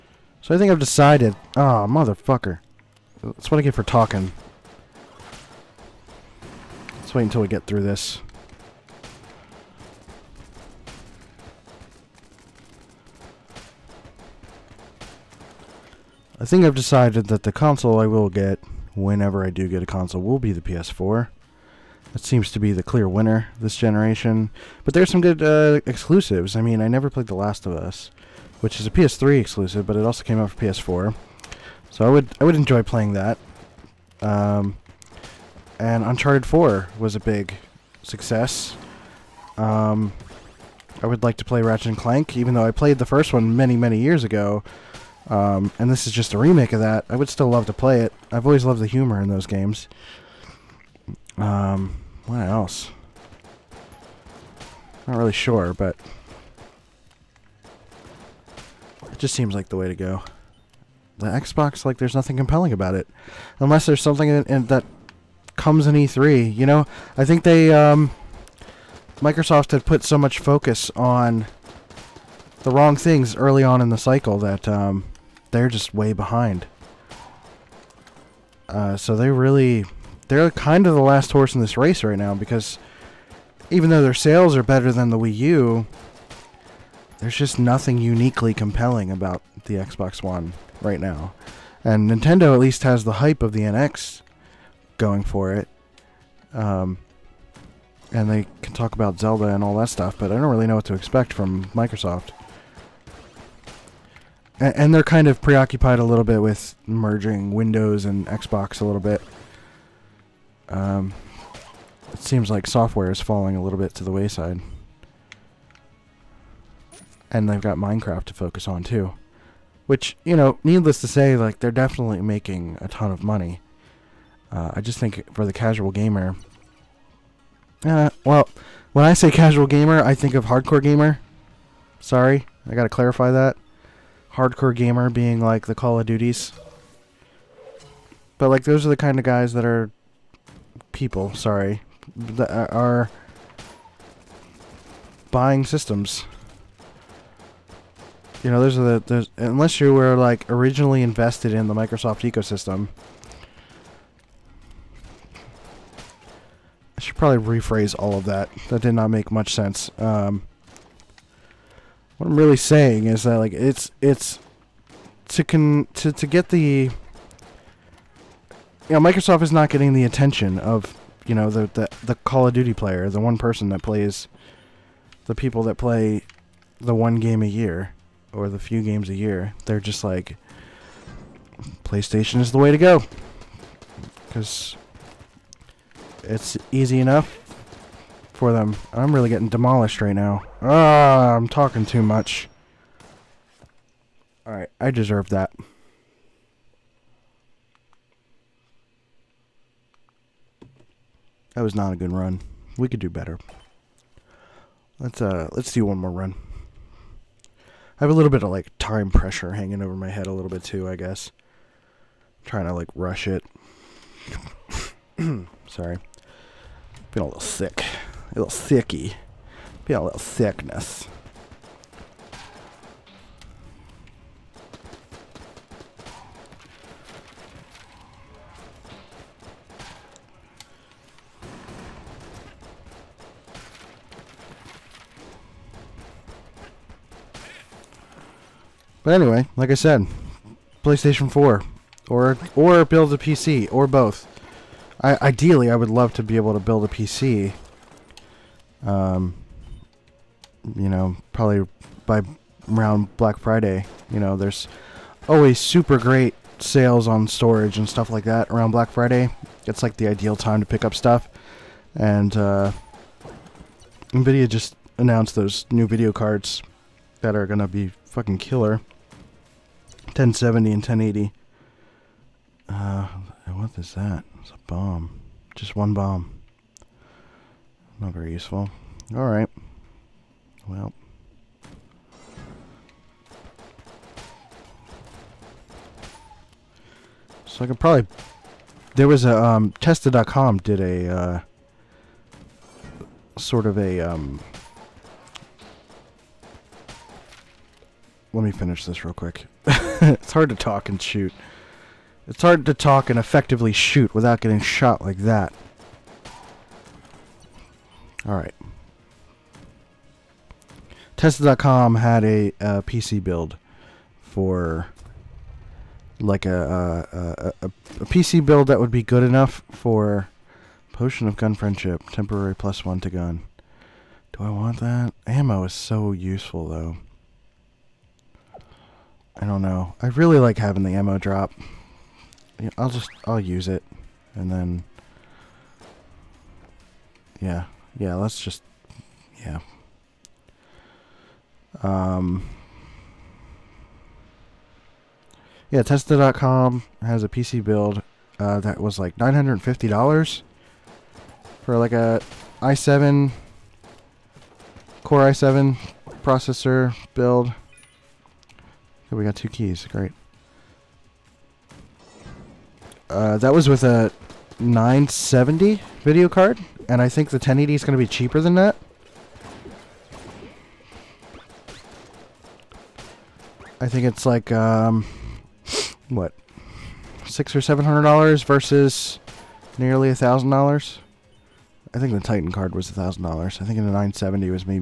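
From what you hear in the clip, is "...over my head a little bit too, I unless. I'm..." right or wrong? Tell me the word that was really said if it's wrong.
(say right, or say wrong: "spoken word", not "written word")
wrong: "guess", not "unless".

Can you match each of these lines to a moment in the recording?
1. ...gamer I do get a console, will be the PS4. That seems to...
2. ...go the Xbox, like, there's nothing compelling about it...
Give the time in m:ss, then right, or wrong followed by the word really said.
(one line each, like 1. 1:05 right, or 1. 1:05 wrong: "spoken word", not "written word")
1. 0:18 wrong: "whenever", not "gamer"
2. 0:59 right.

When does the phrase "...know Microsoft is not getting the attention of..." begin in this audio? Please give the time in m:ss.
2:48.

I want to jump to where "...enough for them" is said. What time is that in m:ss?
3:06.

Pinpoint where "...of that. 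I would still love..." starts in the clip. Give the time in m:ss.
0:46.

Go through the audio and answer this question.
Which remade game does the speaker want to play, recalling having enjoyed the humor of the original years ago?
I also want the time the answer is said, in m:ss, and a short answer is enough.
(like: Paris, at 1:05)
Ratchet and Clank, at 0:41.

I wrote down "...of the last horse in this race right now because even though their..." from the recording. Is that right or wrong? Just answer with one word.
right.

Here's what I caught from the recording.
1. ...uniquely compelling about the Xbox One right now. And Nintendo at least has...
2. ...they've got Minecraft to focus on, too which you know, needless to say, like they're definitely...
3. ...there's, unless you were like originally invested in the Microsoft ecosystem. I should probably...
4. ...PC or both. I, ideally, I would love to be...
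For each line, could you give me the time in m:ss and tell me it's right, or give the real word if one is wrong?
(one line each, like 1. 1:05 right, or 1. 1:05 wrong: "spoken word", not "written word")
1. 1:27 right
2. 1:57 right
3. 2:29 right
4. 4:03 right.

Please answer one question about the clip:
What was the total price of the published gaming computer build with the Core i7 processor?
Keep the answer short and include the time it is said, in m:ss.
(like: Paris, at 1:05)
$950, at 5:49.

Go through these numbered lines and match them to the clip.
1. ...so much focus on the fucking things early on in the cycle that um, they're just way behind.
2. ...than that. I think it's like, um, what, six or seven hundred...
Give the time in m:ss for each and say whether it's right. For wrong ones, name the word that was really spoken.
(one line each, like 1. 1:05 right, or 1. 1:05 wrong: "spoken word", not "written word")
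1. 1:10 wrong: "wrong", not "fucking"
2. 6:08 right.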